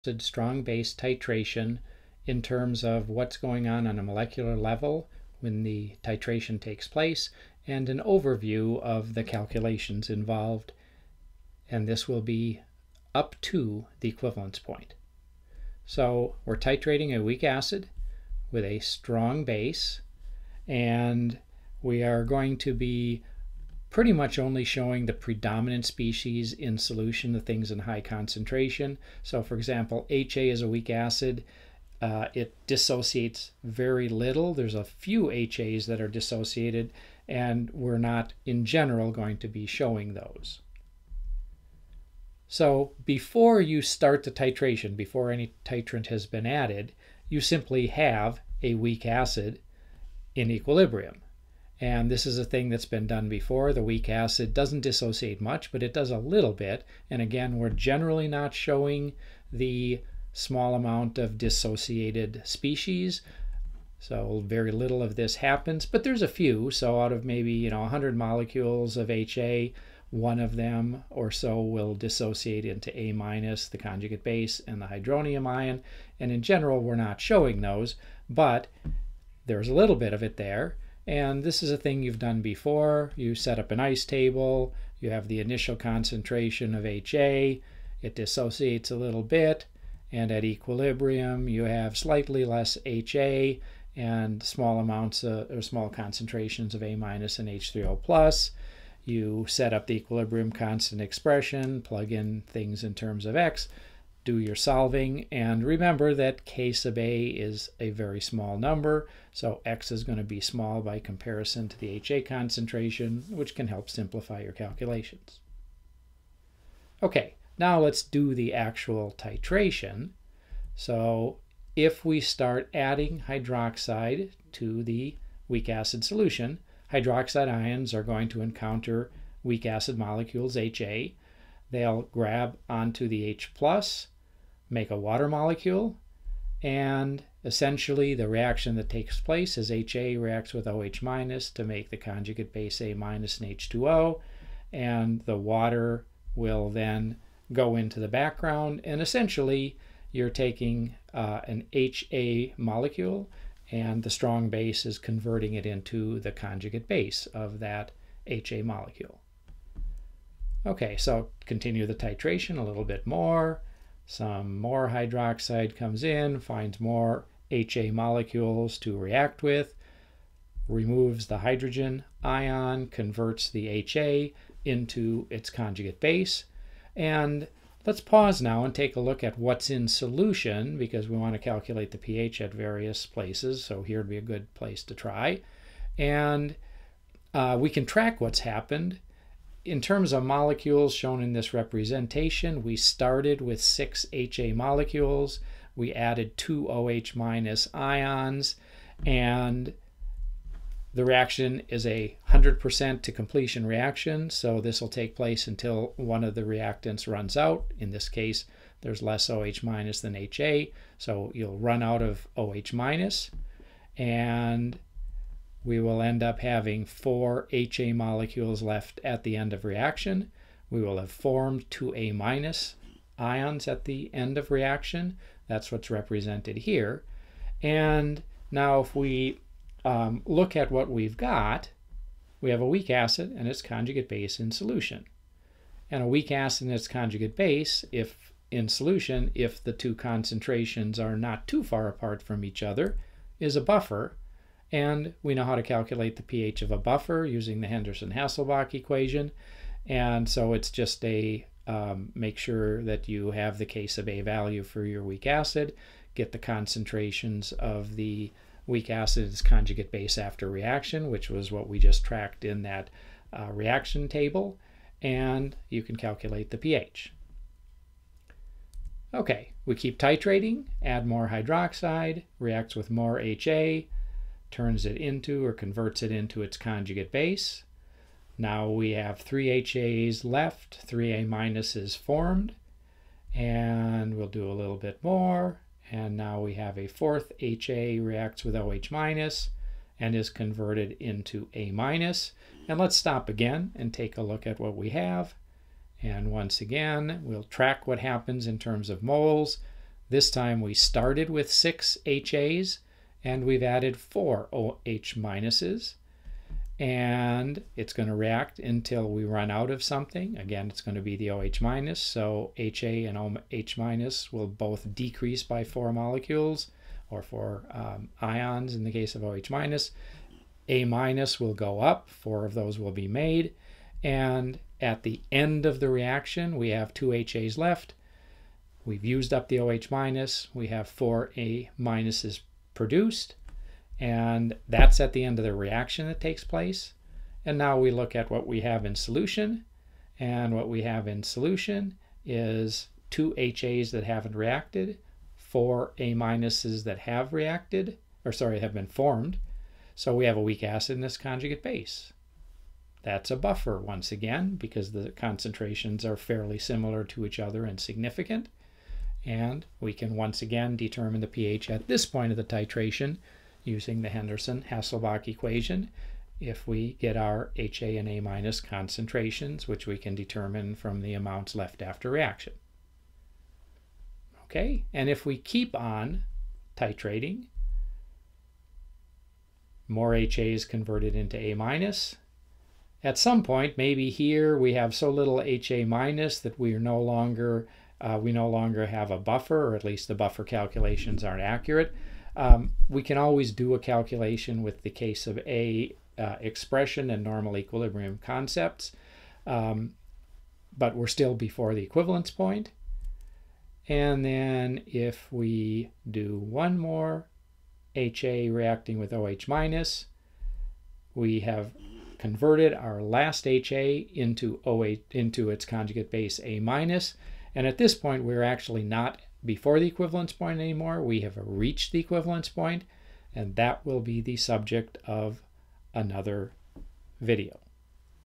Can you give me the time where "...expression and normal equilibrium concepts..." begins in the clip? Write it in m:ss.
6:36.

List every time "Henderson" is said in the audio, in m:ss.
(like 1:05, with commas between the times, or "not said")
4:07, 6:04.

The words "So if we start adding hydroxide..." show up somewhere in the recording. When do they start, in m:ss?
2:00.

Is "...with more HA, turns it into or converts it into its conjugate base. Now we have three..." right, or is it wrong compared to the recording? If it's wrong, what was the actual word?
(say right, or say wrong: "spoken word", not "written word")
right.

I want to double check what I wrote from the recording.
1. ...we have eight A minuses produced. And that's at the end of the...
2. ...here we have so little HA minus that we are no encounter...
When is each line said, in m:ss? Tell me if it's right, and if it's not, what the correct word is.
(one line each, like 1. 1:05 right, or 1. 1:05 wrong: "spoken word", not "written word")
1. 5:30 wrong: "four", not "eight"
2. 6:24 wrong: "longer", not "encounter".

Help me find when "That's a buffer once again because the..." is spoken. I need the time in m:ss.
5:53.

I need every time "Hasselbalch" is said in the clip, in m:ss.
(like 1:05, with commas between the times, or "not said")
4:07, 6:04.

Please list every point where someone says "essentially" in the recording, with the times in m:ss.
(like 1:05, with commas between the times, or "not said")
2:17, 2:29.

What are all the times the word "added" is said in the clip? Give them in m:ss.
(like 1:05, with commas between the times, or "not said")
0:46, 3:15, 5:03.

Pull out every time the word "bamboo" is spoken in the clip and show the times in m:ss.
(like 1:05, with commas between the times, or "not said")
not said.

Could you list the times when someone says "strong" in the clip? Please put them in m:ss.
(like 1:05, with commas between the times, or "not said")
0:00, 0:18, 2:34.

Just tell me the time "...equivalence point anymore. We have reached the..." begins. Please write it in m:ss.
6:59.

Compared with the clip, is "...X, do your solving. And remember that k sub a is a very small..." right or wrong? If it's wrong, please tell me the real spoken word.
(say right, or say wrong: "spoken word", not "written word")
right.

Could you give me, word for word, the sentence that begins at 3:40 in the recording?
We will have formed two A minus ions at the end of reaction.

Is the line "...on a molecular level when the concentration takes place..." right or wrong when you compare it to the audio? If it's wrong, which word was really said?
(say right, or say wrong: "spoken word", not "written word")
wrong: "titration", not "concentration".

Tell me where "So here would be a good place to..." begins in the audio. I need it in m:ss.
3:03.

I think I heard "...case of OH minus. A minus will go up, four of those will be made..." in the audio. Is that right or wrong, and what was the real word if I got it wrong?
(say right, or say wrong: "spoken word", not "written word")
right.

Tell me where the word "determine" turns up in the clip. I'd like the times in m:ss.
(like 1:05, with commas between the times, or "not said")
6:00, 6:10.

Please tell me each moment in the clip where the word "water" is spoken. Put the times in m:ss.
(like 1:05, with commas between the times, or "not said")
2:14, 2:25.